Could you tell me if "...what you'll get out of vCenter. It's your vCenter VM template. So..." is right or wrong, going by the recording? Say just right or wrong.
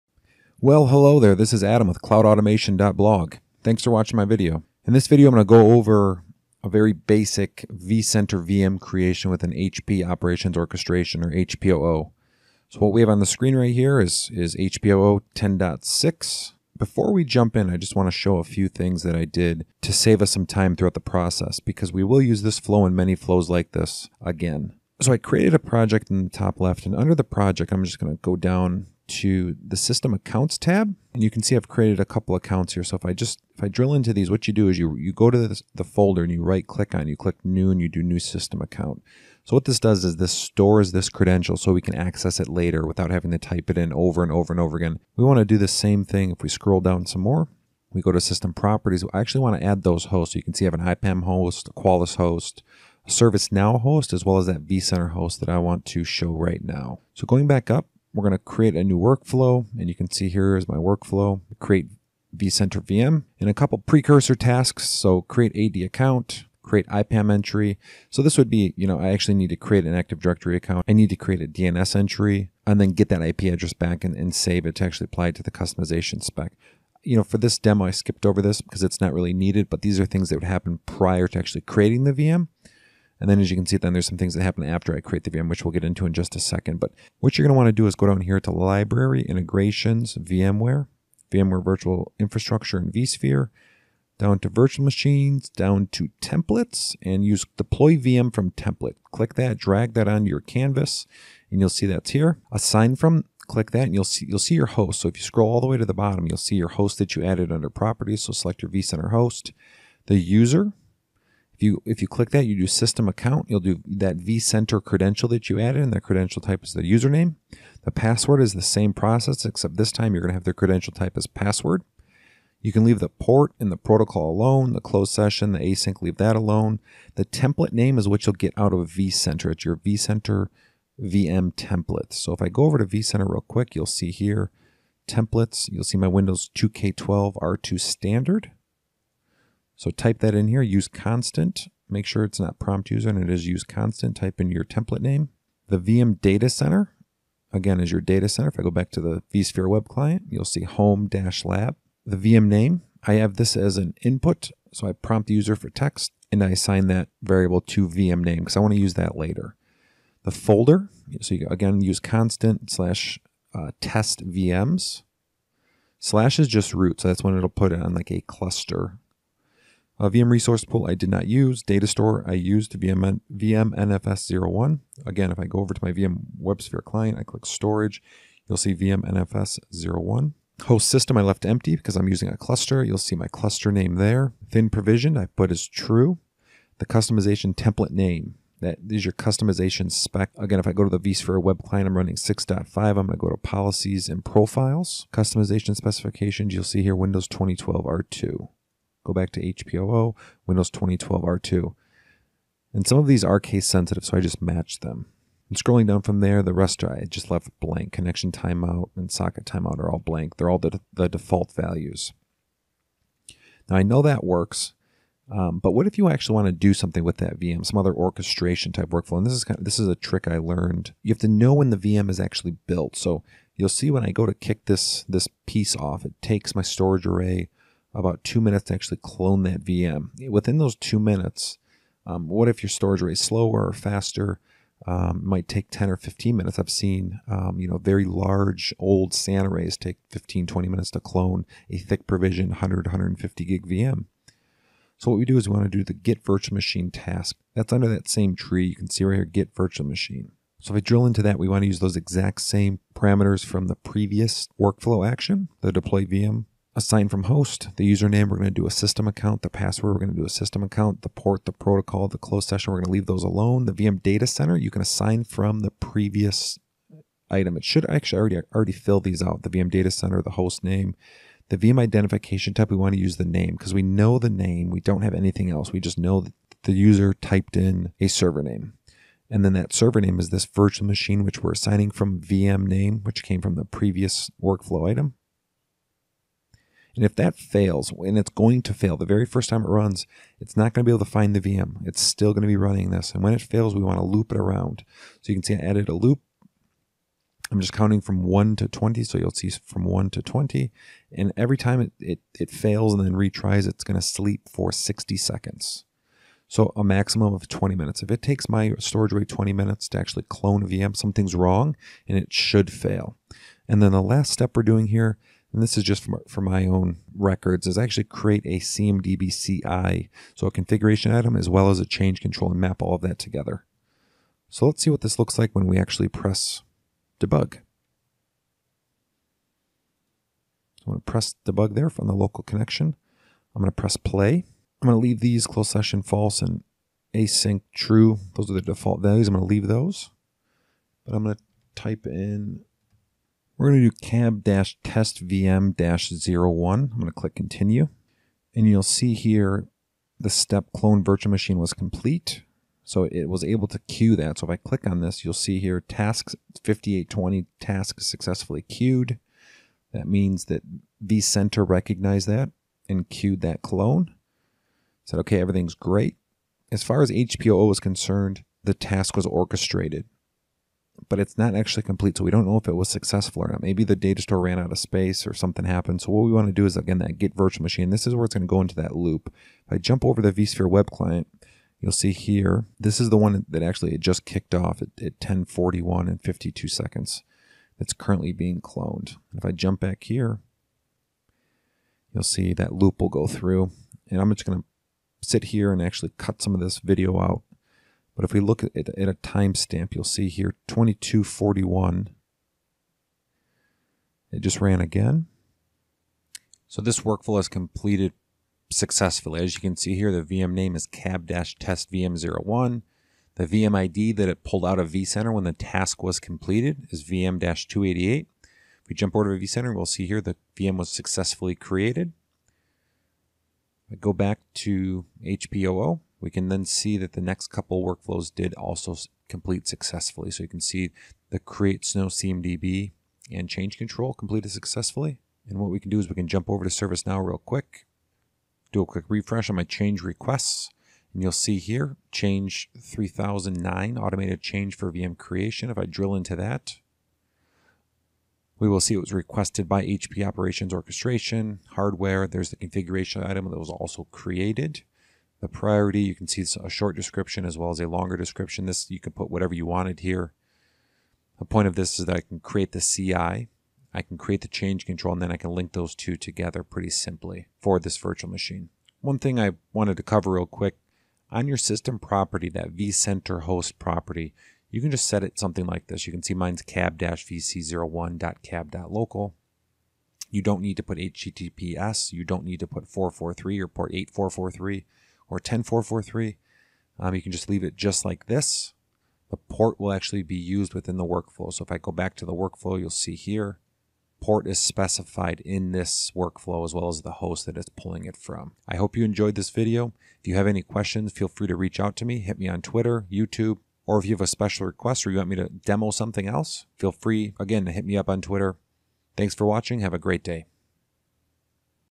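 right.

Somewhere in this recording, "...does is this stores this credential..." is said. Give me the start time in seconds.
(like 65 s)
39 s.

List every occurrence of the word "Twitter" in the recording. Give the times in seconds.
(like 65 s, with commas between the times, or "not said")
502 s, 508 s.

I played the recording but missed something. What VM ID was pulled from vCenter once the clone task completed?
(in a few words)
VM-288.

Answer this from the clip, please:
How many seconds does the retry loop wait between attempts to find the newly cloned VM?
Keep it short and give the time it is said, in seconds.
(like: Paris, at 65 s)
60, at 304 s.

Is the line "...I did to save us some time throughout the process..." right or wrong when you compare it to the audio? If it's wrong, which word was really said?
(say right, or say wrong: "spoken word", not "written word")
right.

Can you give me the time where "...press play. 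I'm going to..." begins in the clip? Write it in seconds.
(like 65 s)
333 s.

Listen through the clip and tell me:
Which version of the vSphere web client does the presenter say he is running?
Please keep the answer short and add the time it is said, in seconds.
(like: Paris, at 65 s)
6.5, at 192 s.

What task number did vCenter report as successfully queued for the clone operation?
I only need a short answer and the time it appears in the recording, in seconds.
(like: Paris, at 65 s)
5820, at 356 s.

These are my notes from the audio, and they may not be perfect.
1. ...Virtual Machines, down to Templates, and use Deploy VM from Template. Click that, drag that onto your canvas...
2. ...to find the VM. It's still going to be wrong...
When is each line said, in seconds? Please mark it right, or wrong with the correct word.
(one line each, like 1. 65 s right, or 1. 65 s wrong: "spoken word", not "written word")
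1. 94 s right
2. 291 s wrong: "running", not "wrong".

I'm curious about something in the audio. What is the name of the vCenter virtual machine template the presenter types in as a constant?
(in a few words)
Windows 2K12 R2 standard.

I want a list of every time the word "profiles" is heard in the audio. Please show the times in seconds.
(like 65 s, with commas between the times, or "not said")
194 s.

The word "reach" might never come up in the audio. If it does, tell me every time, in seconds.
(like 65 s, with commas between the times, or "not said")
501 s.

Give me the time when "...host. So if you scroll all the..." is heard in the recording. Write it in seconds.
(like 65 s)
104 s.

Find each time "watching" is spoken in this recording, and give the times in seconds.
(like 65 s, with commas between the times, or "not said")
3 s, 509 s.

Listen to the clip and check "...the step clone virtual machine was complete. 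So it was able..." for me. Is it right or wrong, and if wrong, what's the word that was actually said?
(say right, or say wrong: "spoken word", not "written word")
right.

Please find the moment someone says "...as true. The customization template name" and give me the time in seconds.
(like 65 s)
185 s.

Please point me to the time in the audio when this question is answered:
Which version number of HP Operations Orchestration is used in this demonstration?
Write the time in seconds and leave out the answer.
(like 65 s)
15 s.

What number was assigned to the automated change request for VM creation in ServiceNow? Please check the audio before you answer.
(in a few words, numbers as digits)
3009.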